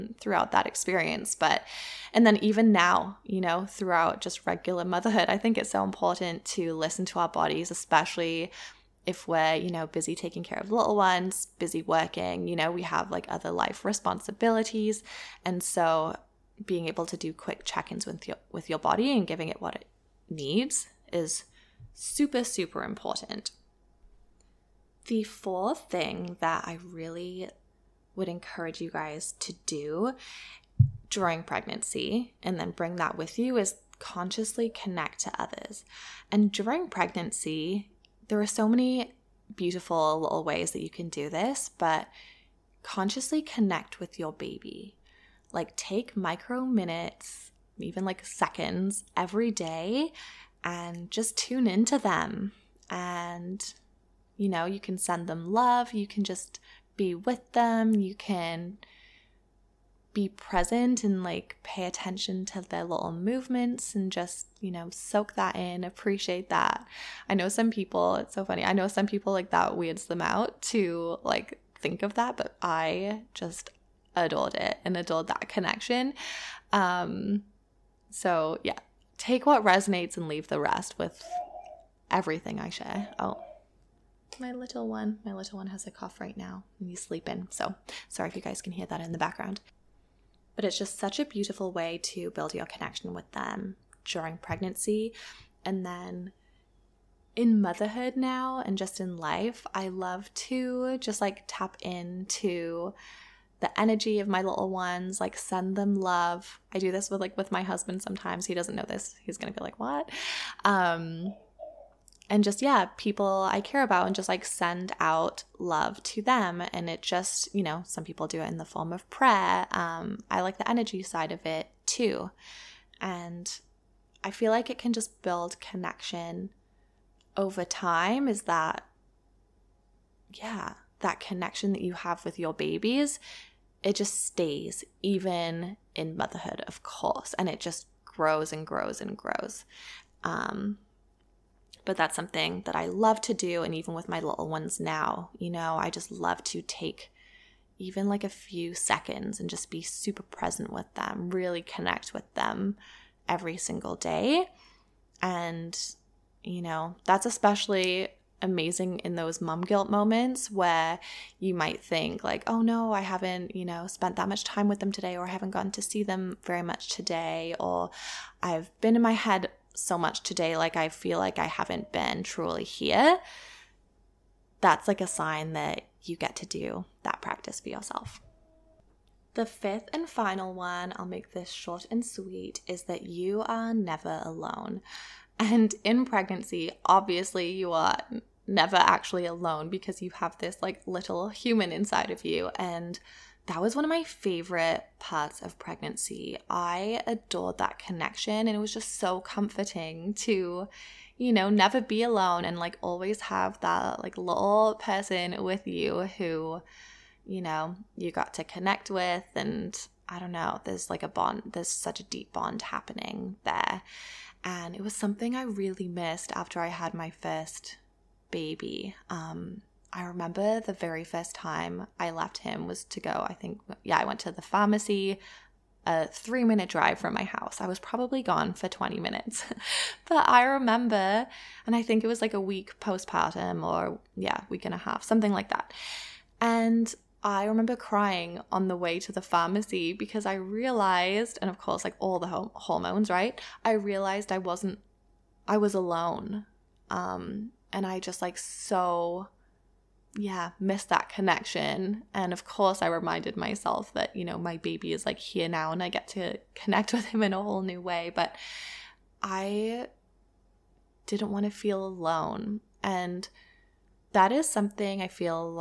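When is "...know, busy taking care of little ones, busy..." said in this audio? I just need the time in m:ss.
0:09.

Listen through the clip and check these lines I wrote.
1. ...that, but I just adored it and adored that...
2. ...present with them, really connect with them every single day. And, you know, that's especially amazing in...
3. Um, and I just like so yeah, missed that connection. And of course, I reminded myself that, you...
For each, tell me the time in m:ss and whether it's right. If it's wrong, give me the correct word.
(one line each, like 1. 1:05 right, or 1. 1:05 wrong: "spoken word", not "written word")
1. 1:12 right
2. 2:30 right
3. 4:06 right.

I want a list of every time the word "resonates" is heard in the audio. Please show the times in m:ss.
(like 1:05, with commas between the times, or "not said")
1:19.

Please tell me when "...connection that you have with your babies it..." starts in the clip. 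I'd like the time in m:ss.
2:11.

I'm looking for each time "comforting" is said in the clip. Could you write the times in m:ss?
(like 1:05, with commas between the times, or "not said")
3:19.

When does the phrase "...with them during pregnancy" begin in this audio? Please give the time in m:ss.
1:33.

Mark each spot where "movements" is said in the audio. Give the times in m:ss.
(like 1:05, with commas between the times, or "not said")
1:03.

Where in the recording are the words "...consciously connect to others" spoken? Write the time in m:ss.
0:33.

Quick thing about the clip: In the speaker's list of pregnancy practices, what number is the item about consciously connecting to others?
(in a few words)
fourth.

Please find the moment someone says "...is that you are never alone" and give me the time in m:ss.
3:02.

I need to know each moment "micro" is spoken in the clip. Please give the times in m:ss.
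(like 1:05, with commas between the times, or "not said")
0:46.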